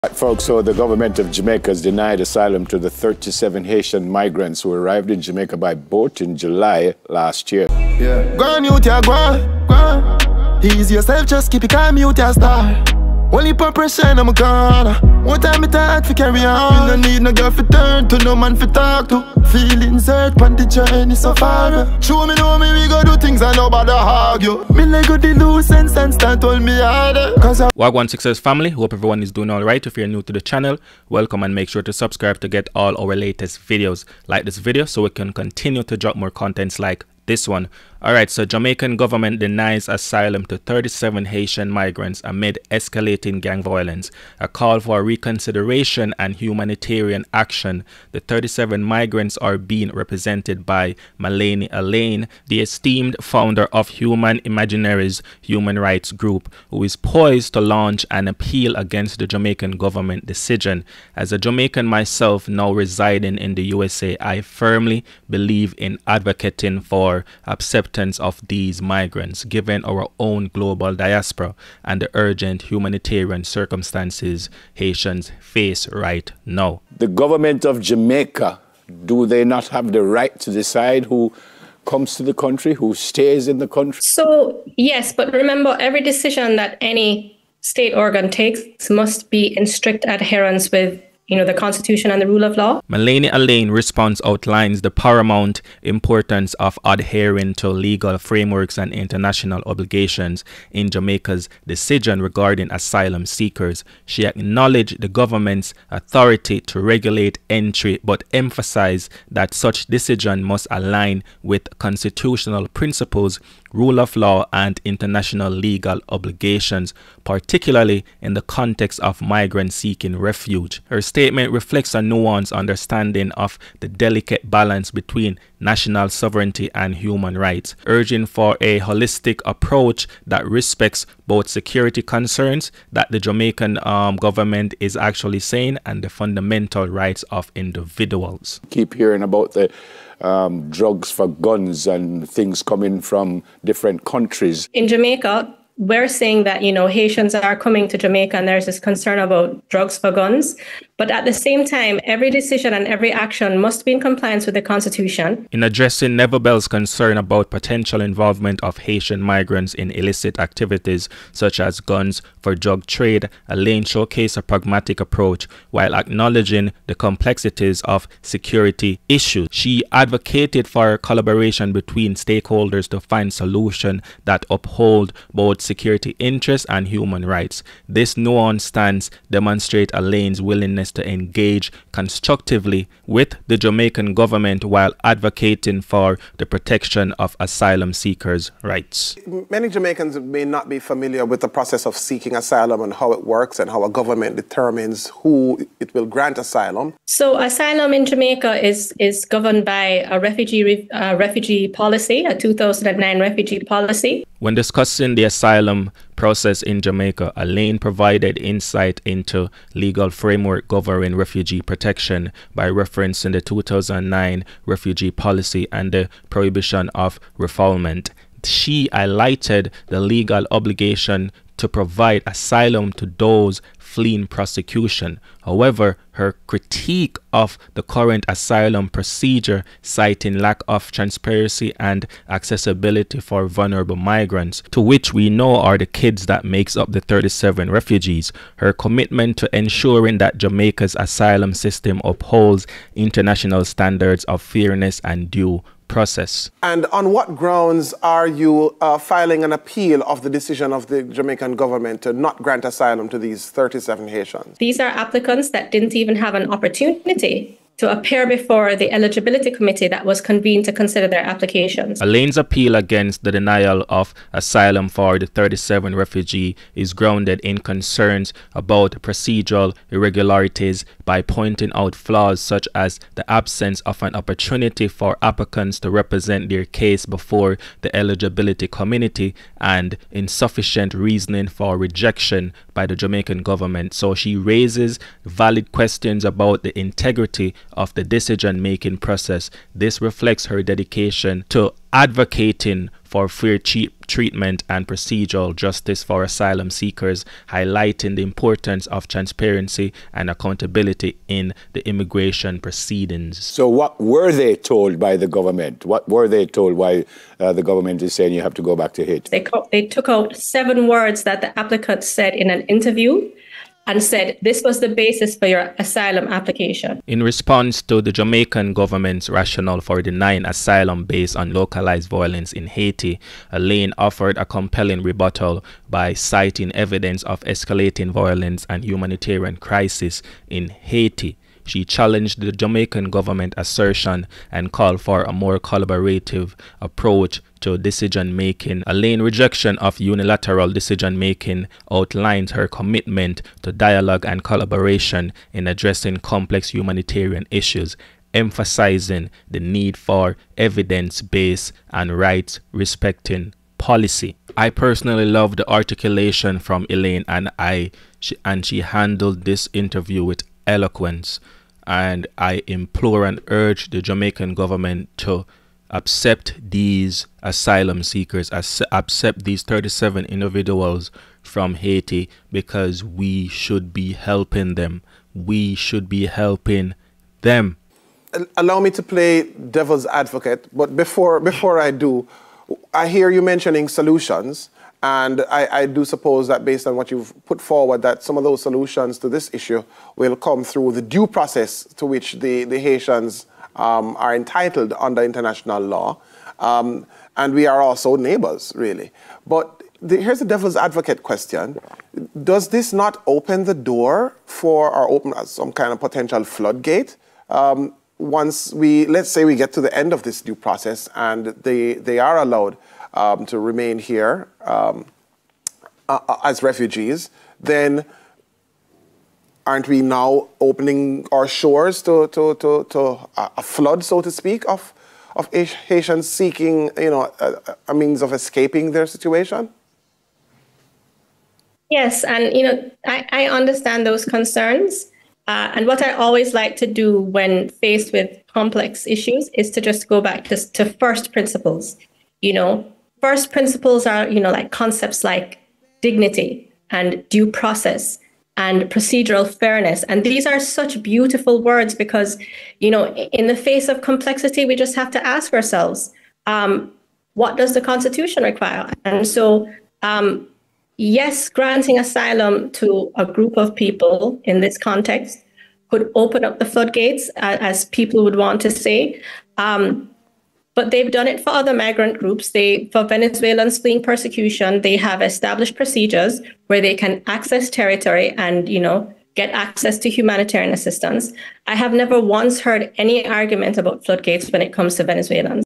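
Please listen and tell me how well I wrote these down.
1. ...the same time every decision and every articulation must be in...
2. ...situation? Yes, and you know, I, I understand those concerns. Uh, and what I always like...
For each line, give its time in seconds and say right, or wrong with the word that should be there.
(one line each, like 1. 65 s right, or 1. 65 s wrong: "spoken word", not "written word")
1. 151 s wrong: "action", not "articulation"
2. 429 s right.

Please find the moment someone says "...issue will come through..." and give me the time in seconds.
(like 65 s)
389 s.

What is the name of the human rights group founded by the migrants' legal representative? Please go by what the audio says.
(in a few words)
Human Imaginaries.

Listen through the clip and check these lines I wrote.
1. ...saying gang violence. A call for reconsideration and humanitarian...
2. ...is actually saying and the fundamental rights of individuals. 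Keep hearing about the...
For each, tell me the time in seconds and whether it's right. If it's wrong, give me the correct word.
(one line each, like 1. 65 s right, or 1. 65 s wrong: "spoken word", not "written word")
1. 42 s wrong: "escalating", not "saying"
2. 134 s right.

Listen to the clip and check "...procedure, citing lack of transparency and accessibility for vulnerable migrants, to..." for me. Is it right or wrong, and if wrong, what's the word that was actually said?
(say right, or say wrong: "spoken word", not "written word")
right.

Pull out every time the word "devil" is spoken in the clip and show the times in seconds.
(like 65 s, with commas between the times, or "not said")
379 s, 400 s.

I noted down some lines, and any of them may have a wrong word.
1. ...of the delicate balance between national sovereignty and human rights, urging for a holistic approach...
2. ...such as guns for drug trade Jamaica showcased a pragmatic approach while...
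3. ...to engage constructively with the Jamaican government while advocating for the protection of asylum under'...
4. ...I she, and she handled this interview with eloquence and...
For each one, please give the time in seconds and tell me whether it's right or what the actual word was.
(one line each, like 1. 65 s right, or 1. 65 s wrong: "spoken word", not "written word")
1. 123 s right
2. 161 s wrong: "Alleyne", not "Jamaica"
3. 180 s wrong: "seekers", not "under"
4. 357 s right.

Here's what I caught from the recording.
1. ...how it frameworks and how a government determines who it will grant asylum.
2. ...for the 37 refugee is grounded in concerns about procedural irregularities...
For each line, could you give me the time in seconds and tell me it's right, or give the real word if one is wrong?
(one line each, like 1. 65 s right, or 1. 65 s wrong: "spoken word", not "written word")
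1. 192 s wrong: "works", not "frameworks"
2. 264 s right.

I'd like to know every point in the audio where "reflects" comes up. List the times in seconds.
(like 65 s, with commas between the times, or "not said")
121 s, 290 s.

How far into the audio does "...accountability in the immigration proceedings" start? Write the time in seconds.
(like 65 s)
300 s.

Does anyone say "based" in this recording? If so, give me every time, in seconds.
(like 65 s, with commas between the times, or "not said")
321 s, 351 s, 386 s.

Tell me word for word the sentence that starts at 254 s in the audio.
These are applicants that didn't even have an opportunity to appear before the eligibility committee that was convened to consider their applications.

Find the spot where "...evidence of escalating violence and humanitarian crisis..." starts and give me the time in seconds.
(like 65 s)
326 s.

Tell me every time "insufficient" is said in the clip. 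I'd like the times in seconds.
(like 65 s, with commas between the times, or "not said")
280 s.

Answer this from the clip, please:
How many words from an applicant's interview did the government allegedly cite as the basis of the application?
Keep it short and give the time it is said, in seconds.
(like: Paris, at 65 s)
7, at 310 s.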